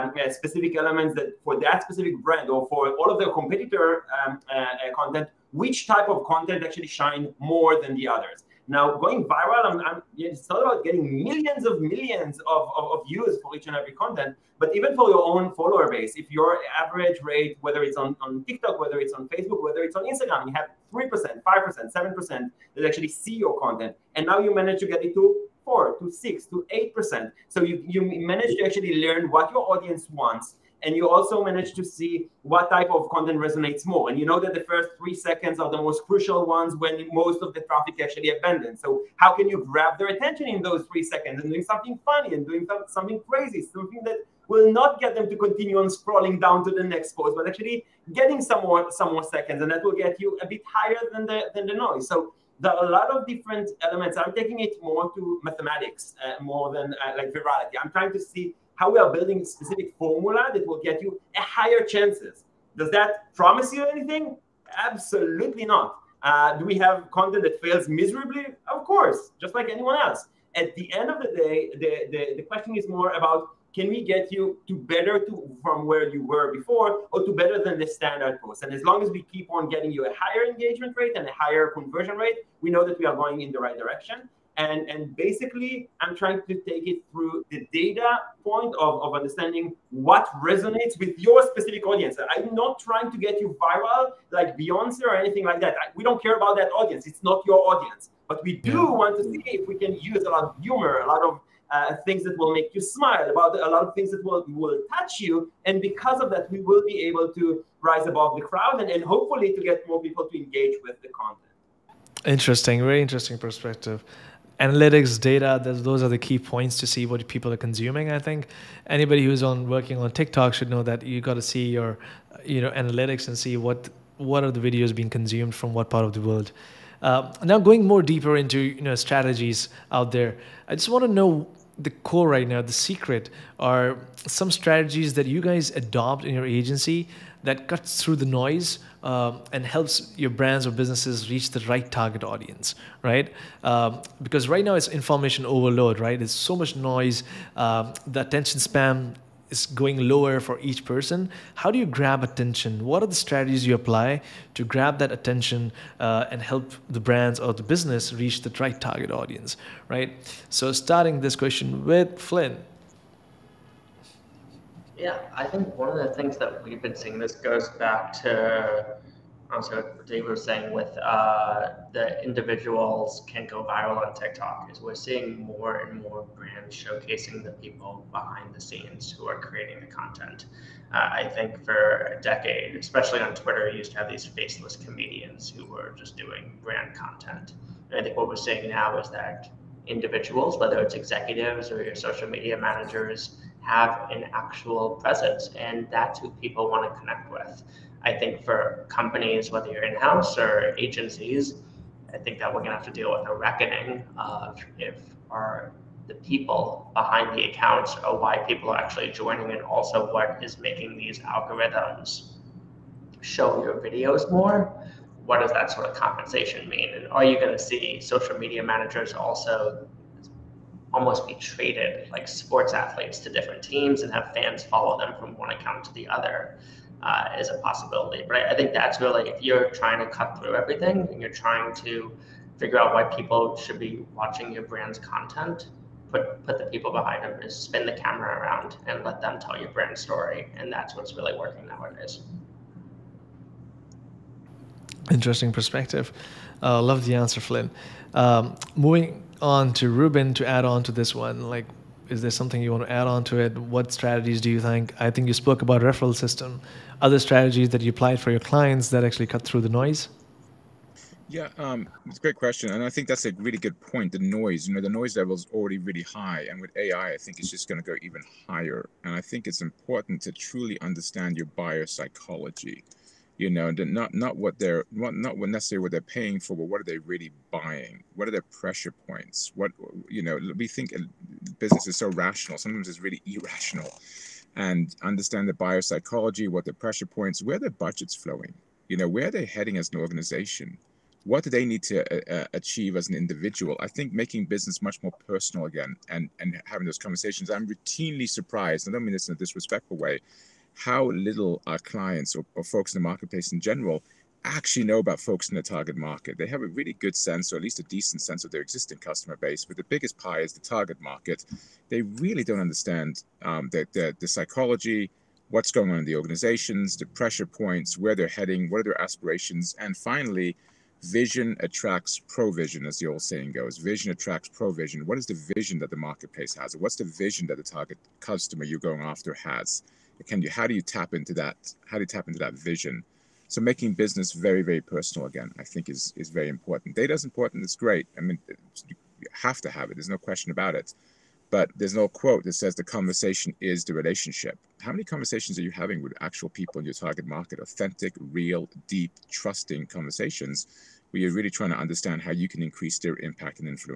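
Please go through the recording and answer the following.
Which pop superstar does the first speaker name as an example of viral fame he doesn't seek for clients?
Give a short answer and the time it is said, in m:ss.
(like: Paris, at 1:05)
Beyonce, at 1:34.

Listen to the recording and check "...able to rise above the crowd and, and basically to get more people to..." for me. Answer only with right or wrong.
wrong.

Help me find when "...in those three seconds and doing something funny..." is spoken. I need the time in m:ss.
0:40.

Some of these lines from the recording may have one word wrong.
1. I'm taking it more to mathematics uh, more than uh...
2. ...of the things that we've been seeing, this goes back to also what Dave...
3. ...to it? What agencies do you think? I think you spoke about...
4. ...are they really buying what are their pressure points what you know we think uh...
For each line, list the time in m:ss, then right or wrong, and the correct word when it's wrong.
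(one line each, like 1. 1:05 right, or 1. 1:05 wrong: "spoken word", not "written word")
1. 0:54 right
2. 2:45 right
3. 4:13 wrong: "strategies", not "agencies"
4. 4:36 right.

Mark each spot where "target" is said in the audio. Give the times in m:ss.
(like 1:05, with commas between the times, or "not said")
2:21, 2:38, 5:05, 5:10, 5:27, 5:46.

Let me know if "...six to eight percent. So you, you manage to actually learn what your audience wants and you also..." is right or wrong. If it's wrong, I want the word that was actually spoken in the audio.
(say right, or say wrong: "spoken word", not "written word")
right.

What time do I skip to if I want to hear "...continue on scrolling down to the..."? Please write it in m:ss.
0:45.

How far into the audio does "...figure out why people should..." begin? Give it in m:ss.
3:52.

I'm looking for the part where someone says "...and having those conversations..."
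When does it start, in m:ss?
4:56.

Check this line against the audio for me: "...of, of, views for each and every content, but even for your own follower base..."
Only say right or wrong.
right.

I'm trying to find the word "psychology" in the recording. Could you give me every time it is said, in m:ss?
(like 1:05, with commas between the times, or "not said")
4:31, 4:45, 5:14.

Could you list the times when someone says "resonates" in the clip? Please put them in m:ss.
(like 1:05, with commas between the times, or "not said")
0:33, 1:30.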